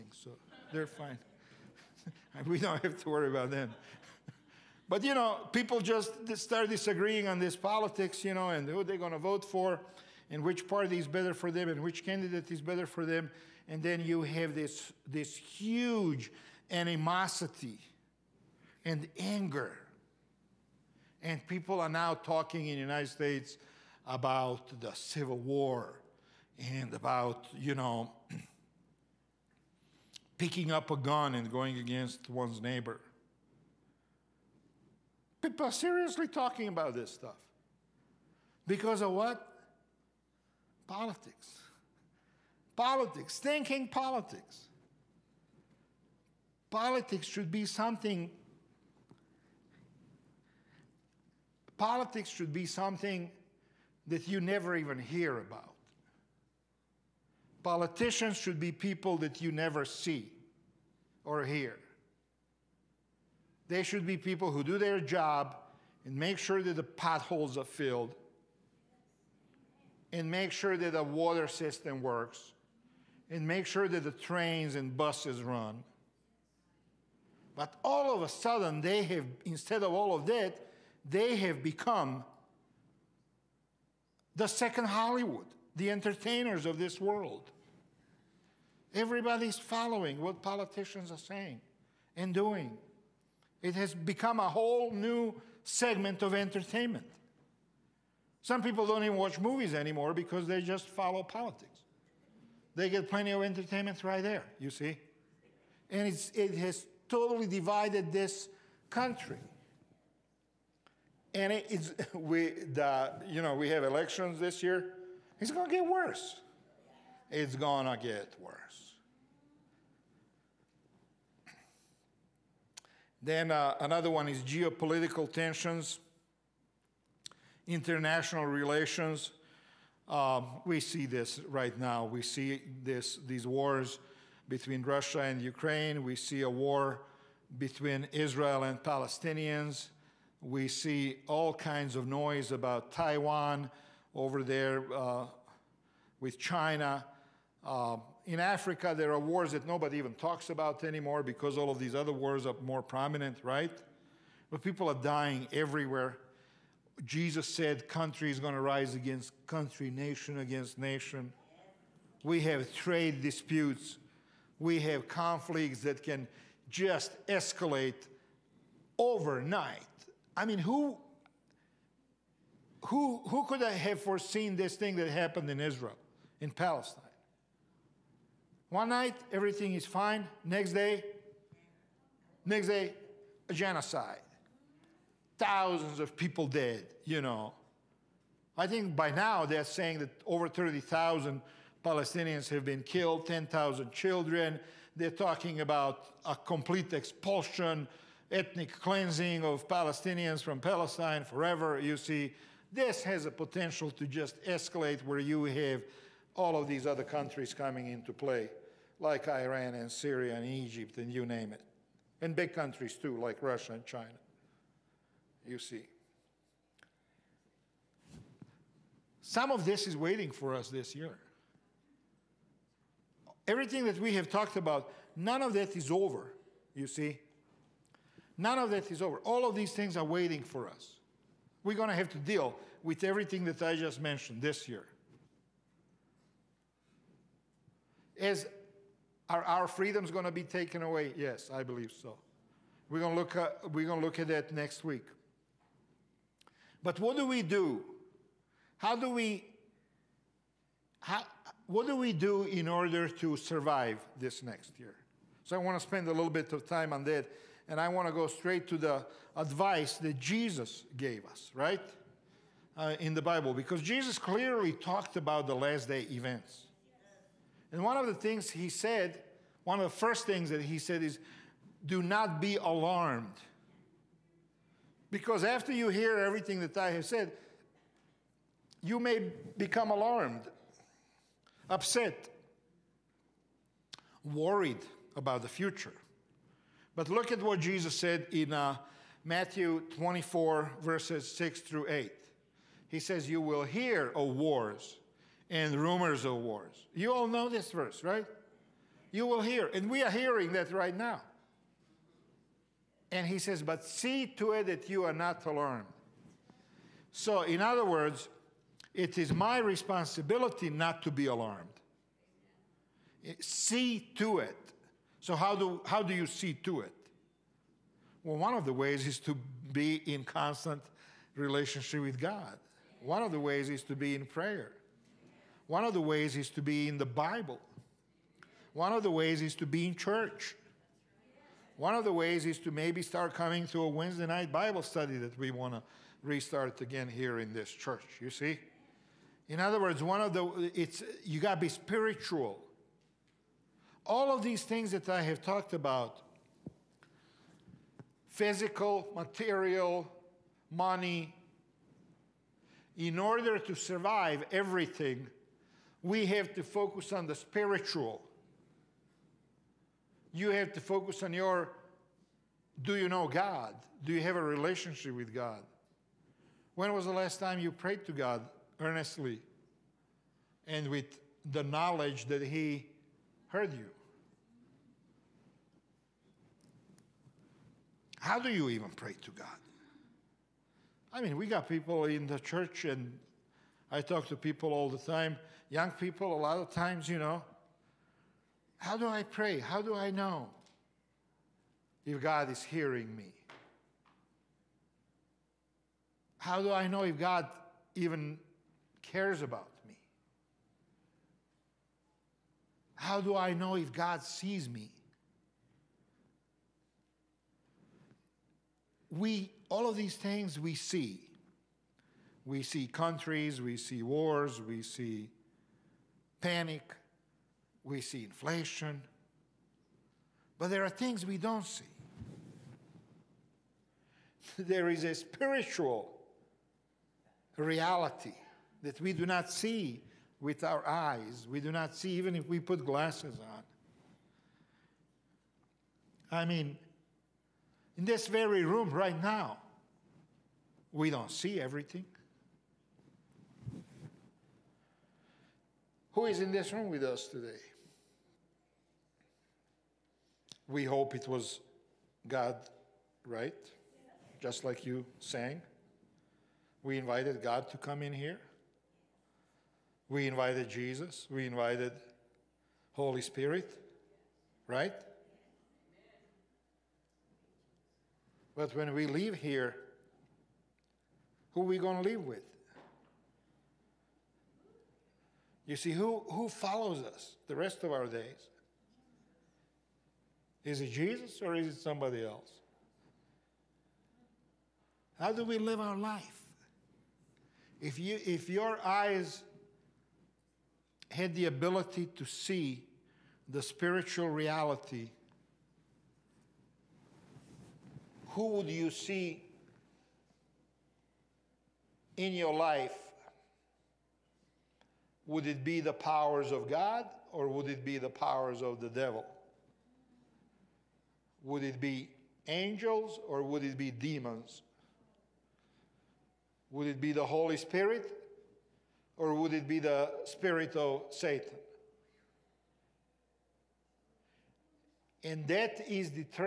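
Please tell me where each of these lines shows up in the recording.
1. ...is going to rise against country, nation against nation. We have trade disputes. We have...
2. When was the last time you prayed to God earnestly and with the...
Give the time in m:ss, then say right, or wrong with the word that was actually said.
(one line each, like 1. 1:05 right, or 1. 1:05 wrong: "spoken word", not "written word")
1. 2:38 right
2. 6:06 right.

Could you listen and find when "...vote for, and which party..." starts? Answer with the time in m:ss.
0:09.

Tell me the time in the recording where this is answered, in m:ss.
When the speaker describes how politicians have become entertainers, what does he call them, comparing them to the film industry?
1:24.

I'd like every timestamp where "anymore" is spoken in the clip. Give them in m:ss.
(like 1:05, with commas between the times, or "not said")
1:39, 2:30.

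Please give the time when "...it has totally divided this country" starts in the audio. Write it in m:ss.
1:46.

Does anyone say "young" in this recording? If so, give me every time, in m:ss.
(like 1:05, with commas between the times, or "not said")
6:25.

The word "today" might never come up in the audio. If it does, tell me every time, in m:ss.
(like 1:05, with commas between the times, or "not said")
7:27.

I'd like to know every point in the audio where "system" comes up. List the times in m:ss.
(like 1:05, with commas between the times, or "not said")
1:11.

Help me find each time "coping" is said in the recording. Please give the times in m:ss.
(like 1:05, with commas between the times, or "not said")
not said.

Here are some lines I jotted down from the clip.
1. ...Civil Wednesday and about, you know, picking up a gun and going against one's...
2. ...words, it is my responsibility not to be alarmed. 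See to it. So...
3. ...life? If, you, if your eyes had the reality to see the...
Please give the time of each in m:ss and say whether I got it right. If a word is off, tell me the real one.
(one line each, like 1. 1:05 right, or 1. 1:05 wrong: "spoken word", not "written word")
1. 0:24 wrong: "War", not "Wednesday"
2. 5:07 right
3. 8:05 wrong: "ability", not "reality".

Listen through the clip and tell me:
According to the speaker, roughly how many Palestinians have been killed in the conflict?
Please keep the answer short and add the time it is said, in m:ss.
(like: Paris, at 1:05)
over 30,000, at 3:10.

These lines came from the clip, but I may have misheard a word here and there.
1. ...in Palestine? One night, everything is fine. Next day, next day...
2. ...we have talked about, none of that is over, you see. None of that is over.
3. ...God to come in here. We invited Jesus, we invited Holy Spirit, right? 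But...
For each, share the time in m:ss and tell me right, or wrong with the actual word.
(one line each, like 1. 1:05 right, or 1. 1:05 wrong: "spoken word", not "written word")
1. 2:56 right
2. 3:44 right
3. 7:37 right.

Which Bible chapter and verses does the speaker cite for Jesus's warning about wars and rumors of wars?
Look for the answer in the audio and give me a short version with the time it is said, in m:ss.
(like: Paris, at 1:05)
Matthew 24:6-8, at 4:49.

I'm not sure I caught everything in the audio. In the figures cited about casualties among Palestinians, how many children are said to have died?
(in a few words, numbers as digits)
10,000.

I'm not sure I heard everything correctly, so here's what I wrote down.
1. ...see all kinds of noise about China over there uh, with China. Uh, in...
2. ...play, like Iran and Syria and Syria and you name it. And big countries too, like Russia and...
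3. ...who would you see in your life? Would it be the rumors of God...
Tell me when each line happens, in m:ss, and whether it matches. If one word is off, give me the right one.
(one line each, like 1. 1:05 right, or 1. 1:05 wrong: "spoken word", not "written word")
1. 2:20 wrong: "Taiwan", not "China"
2. 3:28 wrong: "Egypt", not "Syria"
3. 8:18 wrong: "powers", not "rumors".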